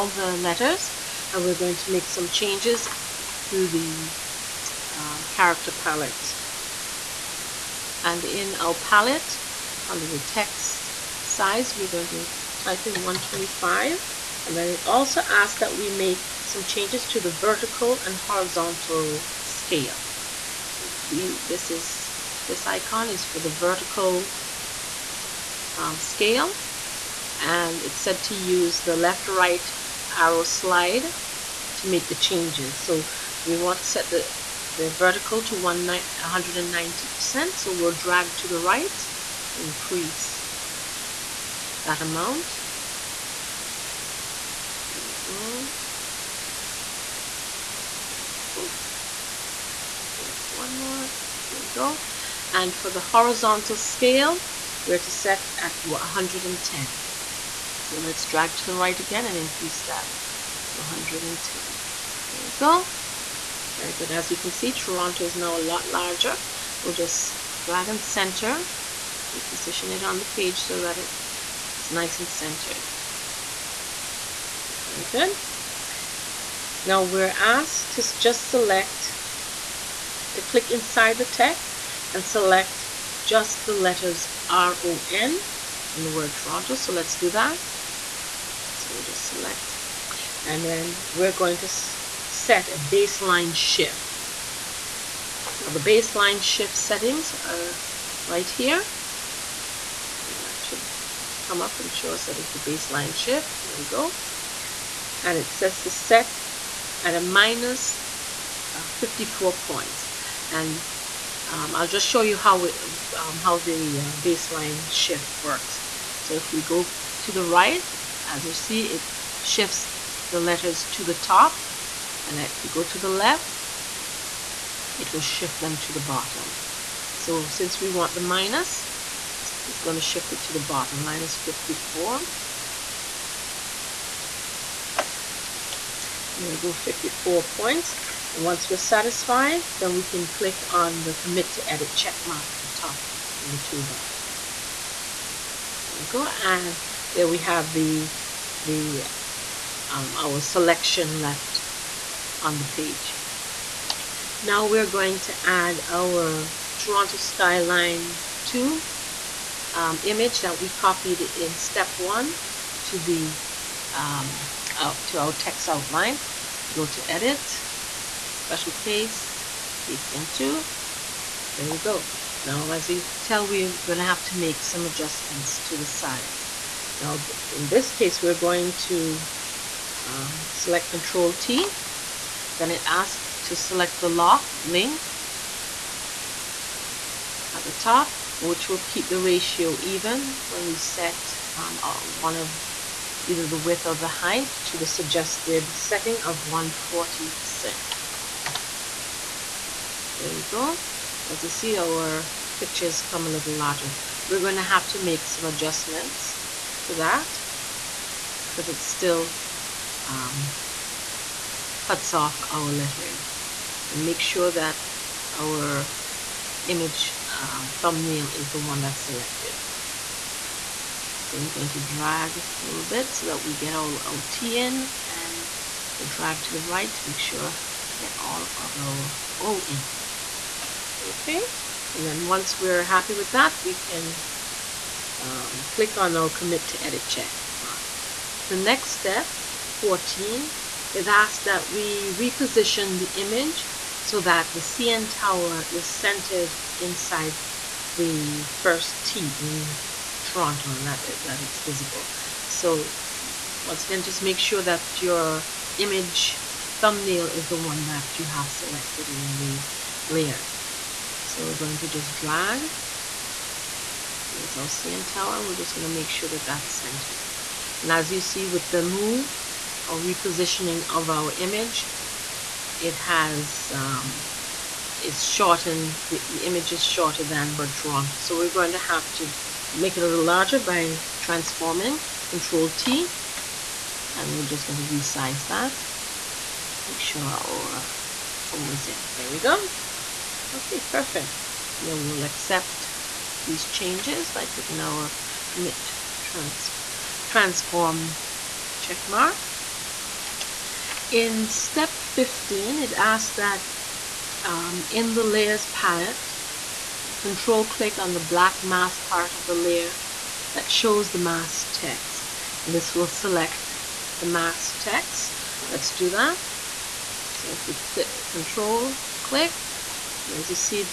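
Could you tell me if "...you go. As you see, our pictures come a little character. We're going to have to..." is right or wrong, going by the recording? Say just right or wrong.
wrong.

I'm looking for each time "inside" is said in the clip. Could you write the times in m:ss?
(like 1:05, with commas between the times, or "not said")
1:20, 4:06.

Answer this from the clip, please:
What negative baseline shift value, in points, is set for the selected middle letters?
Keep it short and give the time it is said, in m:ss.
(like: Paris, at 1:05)
-54, at 2:11.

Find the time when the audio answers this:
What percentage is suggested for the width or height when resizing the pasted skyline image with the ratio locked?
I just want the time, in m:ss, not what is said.
3:16.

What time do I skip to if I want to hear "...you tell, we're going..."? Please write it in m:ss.
2:52.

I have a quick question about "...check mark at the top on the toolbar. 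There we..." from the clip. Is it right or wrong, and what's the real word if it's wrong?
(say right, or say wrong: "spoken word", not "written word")
right.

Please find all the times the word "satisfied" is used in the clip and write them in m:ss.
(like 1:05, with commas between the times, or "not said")
2:18.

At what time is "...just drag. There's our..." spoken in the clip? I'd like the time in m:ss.
4:21.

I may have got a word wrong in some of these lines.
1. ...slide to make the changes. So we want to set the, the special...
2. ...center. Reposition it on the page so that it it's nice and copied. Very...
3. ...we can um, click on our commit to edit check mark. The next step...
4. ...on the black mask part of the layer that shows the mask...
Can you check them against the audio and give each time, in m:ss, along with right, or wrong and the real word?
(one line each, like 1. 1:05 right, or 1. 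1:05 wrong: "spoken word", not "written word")
1. 0:30 wrong: "vertical", not "special"
2. 1:08 wrong: "centered", not "copied"
3. 3:53 right
4. 5:07 right.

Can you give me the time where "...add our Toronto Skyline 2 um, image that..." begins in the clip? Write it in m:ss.
2:35.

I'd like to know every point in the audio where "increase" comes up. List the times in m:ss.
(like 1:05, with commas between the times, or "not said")
0:39, 0:59.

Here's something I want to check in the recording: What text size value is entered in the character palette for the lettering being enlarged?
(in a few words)
125.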